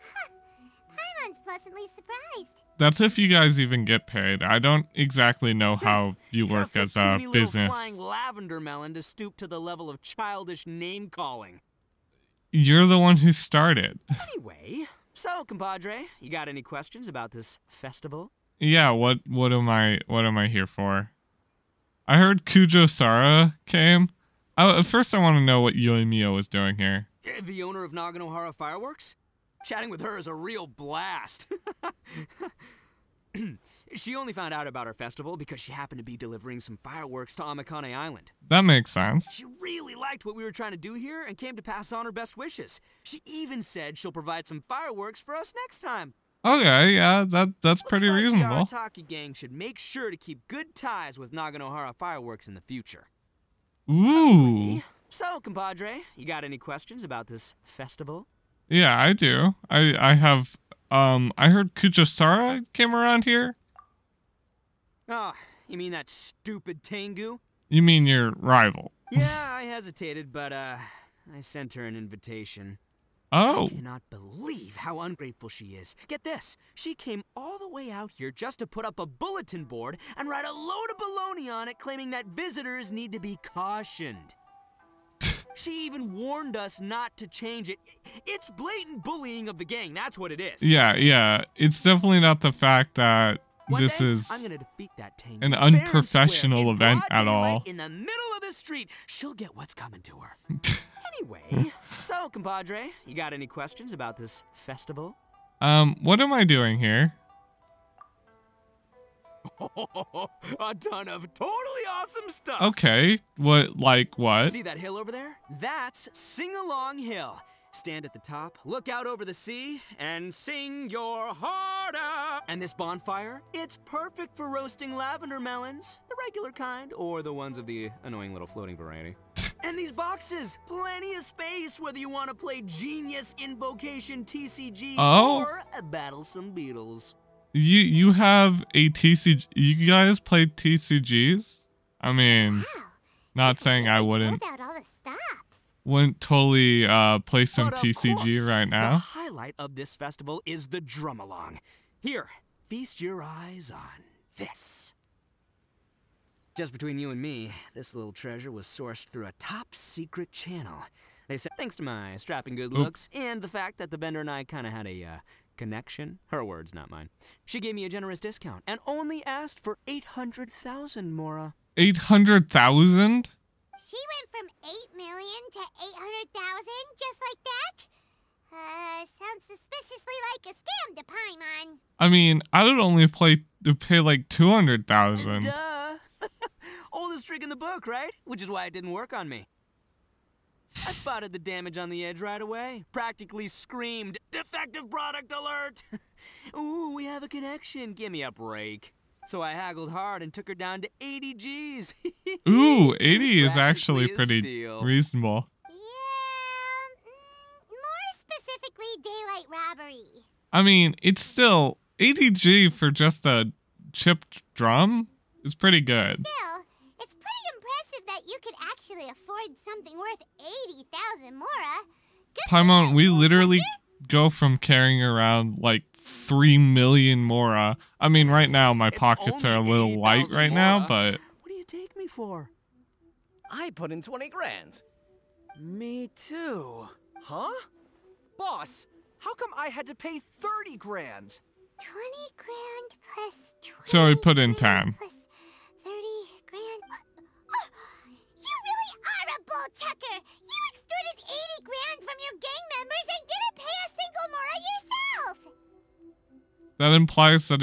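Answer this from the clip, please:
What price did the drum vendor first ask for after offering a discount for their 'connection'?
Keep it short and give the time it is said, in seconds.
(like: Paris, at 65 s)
800,000 Mora, at 169 s.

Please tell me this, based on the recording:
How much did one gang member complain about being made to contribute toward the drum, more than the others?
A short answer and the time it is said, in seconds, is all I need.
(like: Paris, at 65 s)
30 grand, at 240 s.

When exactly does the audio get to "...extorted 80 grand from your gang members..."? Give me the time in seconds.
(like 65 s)
250 s.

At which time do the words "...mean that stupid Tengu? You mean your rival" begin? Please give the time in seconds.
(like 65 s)
65 s.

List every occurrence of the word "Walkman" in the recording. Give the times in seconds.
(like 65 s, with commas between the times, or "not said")
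not said.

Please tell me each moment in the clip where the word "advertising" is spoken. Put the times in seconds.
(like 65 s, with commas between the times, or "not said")
not said.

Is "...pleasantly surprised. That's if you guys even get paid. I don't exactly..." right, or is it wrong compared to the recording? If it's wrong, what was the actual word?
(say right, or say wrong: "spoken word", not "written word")
right.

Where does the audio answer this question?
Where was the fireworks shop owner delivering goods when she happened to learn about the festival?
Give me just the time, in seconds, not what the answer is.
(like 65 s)
37 s.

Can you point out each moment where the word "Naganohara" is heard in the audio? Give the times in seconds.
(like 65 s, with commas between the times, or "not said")
27 s, 51 s.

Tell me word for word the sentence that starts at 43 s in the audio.
She even said she'll provide some fireworks for us next time.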